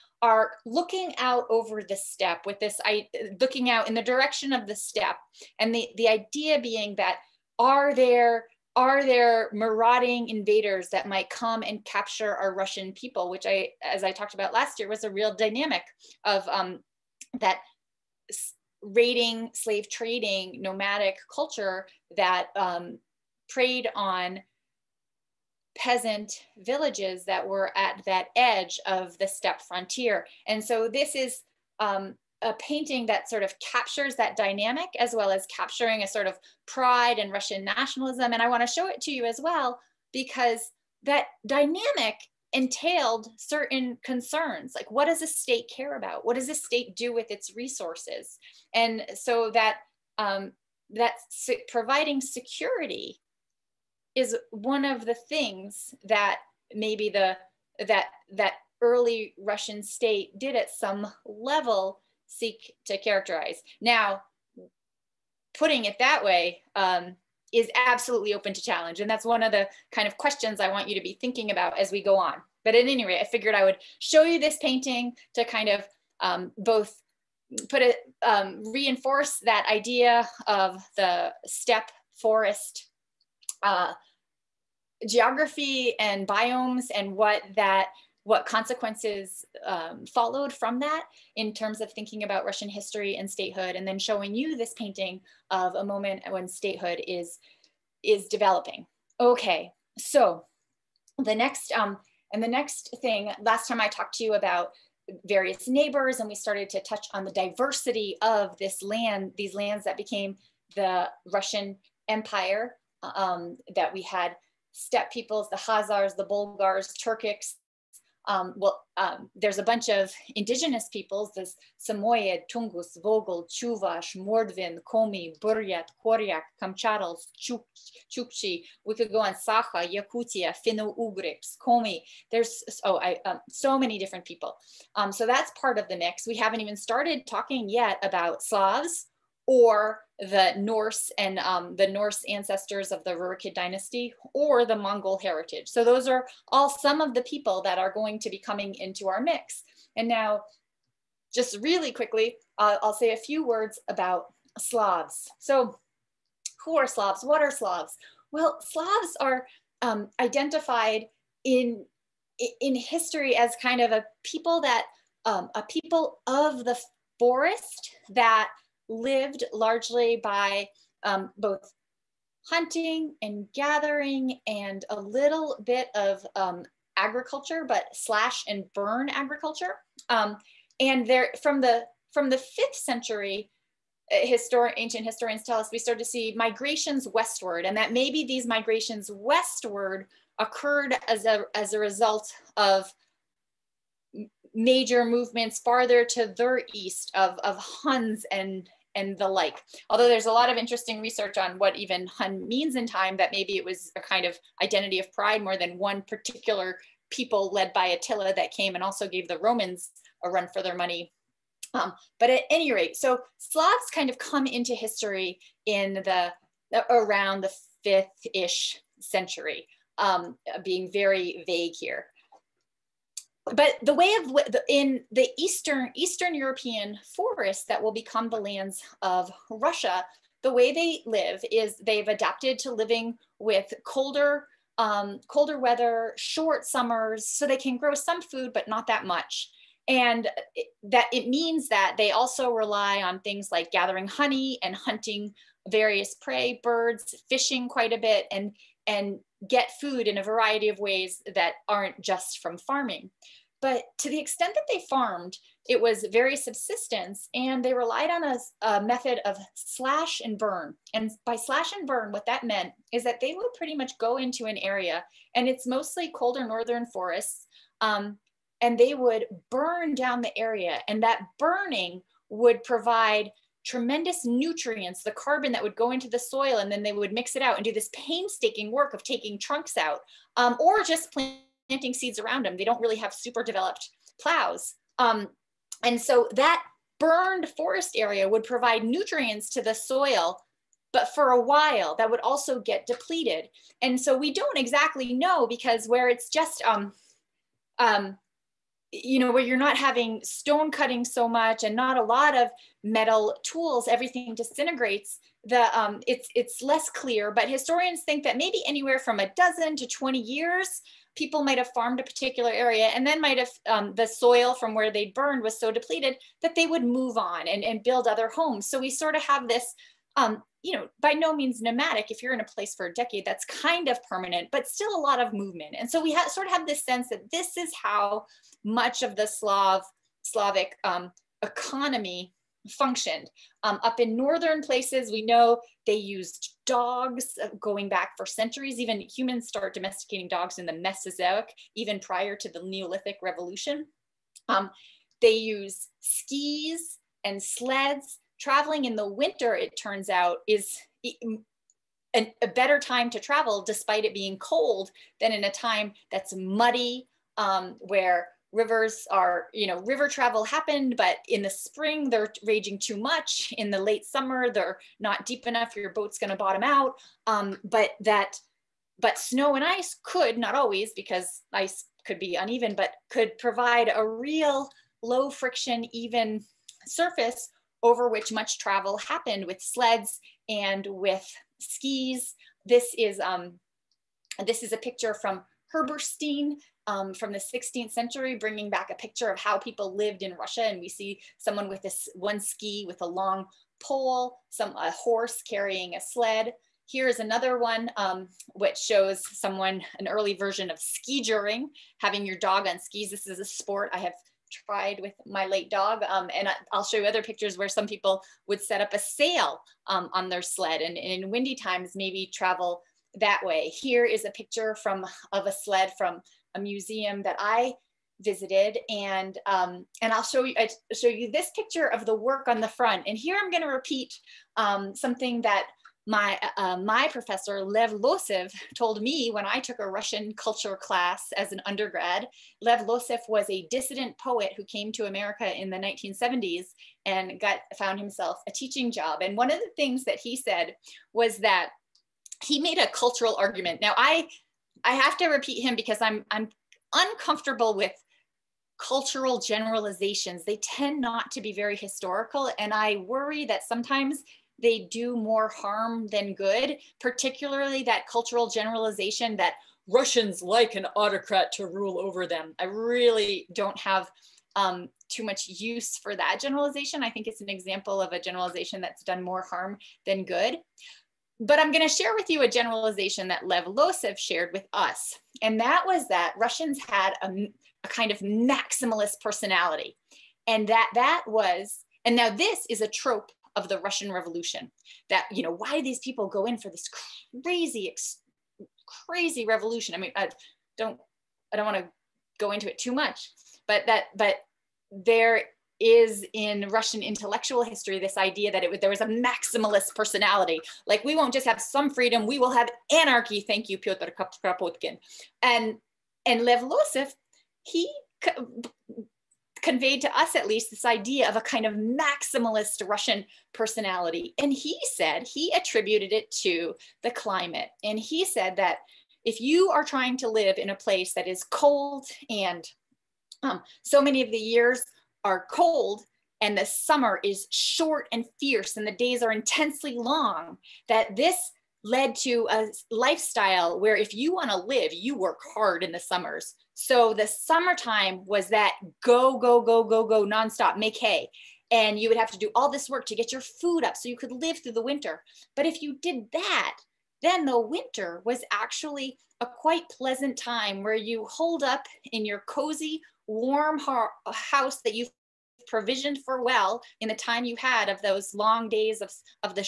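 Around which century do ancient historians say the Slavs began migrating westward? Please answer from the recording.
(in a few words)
5th century.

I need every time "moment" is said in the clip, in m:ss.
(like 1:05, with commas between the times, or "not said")
1:35.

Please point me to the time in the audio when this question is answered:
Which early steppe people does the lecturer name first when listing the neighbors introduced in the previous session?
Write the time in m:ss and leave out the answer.
1:55.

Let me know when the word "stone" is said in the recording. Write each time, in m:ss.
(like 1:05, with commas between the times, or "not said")
5:00.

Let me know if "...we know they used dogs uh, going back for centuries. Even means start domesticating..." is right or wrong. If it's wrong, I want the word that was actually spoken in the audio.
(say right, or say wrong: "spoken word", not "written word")
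wrong: "humans", not "means".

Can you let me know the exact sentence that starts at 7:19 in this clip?
And one of the things that he said was that he made a cultural argument.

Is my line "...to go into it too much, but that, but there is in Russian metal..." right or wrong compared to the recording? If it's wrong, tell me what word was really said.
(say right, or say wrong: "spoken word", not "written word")
wrong: "intellectual", not "metal".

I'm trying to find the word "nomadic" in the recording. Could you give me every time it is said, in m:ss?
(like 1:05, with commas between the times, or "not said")
0:20, 5:21.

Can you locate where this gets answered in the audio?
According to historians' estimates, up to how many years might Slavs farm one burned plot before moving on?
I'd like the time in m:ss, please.
5:09.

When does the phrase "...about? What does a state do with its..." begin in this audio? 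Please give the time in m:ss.
0:45.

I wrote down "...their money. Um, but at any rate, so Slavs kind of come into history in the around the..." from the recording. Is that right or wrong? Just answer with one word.
right.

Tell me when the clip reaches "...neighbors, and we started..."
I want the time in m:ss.
1:45.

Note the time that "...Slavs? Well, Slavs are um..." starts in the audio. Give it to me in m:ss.
2:37.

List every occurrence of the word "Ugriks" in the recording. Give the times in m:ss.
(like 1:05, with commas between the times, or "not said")
2:10.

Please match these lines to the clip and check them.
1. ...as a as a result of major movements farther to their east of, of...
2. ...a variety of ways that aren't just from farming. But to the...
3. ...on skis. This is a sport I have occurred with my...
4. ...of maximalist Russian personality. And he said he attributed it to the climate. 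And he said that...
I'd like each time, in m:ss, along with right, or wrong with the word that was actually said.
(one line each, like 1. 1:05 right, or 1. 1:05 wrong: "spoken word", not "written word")
1. 3:11 right
2. 4:10 right
3. 6:42 wrong: "tried", not "occurred"
4. 8:31 right.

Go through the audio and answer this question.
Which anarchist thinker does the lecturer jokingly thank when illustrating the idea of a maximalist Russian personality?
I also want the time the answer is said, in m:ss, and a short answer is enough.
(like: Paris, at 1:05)
Pyotr Kropotkin, at 8:23.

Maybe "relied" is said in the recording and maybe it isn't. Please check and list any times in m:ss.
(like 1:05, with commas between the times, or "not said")
4:17.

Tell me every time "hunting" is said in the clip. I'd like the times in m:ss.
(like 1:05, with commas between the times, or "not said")
2:52, 4:04.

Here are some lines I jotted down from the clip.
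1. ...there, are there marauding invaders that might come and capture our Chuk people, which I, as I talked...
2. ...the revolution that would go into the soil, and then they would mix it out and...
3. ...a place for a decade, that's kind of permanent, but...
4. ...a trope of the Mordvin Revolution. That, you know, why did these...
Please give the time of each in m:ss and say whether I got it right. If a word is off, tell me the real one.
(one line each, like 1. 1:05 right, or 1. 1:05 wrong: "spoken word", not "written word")
1. 0:07 wrong: "Russian", not "Chuk"
2. 4:35 wrong: "carbon", not "revolution"
3. 5:22 right
4. 8:02 wrong: "Russian", not "Mordvin".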